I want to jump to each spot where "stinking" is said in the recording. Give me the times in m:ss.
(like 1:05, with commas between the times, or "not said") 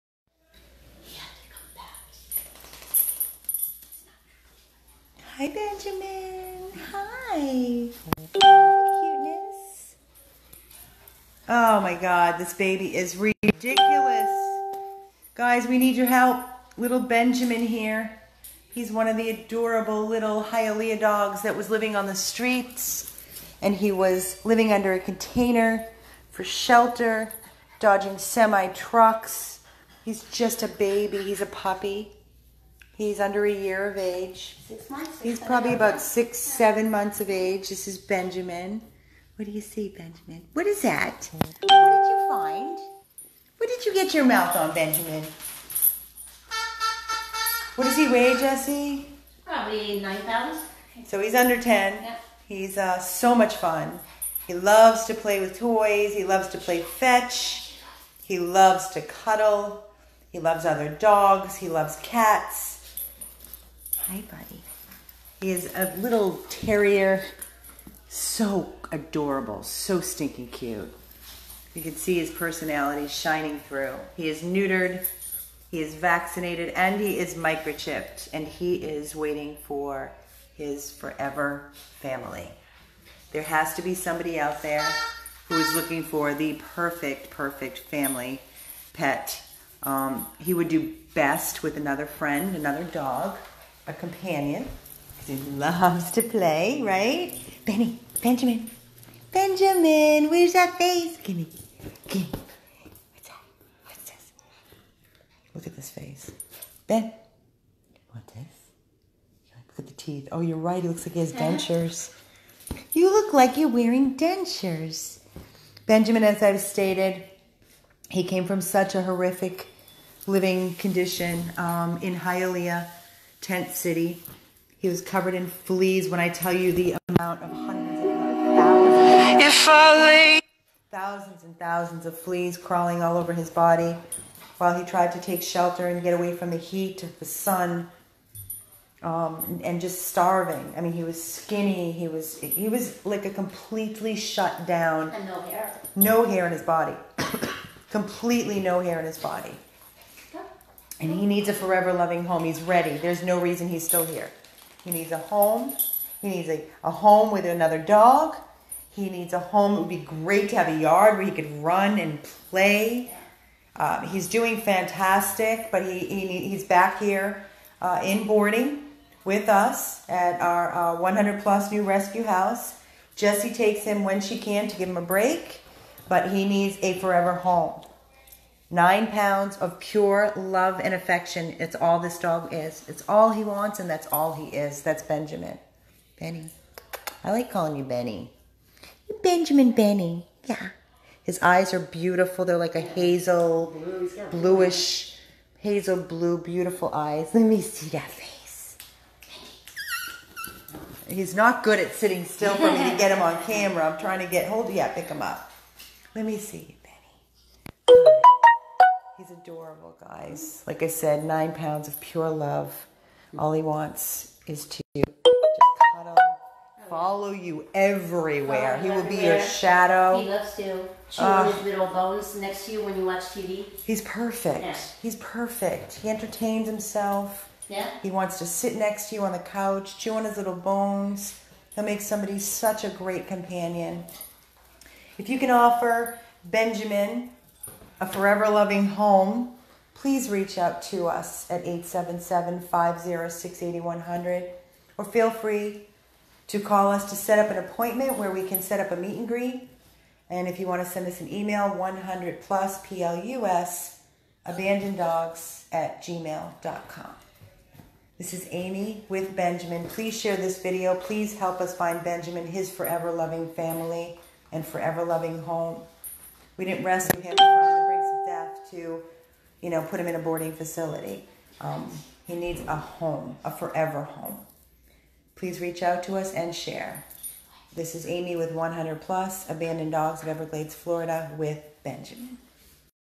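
1:10.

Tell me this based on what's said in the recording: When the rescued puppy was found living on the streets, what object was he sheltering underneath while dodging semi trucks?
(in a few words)
a container.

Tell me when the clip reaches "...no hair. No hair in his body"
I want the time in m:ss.
2:25.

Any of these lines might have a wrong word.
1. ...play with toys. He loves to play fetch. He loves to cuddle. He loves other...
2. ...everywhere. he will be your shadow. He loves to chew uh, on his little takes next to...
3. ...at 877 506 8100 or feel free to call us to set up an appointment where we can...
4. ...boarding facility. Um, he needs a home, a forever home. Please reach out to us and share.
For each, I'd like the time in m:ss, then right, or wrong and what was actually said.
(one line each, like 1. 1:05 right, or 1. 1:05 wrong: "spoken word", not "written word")
1. 0:55 right
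2. 3:37 wrong: "bones", not "takes"
3. 4:01 right
4. 4:30 right.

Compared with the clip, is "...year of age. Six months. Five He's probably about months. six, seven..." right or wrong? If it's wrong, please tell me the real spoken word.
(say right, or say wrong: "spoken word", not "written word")
wrong: "Six", not "Five".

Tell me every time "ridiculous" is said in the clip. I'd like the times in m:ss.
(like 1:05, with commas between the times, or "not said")
0:13.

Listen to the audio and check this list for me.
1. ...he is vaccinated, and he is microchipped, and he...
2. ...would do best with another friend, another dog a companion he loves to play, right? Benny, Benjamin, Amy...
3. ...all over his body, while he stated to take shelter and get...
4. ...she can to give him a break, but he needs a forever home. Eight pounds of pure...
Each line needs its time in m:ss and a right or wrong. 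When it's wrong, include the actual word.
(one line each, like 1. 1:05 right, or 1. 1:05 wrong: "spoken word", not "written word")
1. 1:15 right
2. 1:30 wrong: "Benjamin", not "Amy"
3. 2:13 wrong: "tried", not "stated"
4. 2:54 wrong: "Nine", not "Eight".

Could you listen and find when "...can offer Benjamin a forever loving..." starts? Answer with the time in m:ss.
3:55.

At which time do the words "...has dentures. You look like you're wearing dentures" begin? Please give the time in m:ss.
1:51.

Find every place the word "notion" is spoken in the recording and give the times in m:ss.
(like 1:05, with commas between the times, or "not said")
not said.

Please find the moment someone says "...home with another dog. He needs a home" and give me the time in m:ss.
2:36.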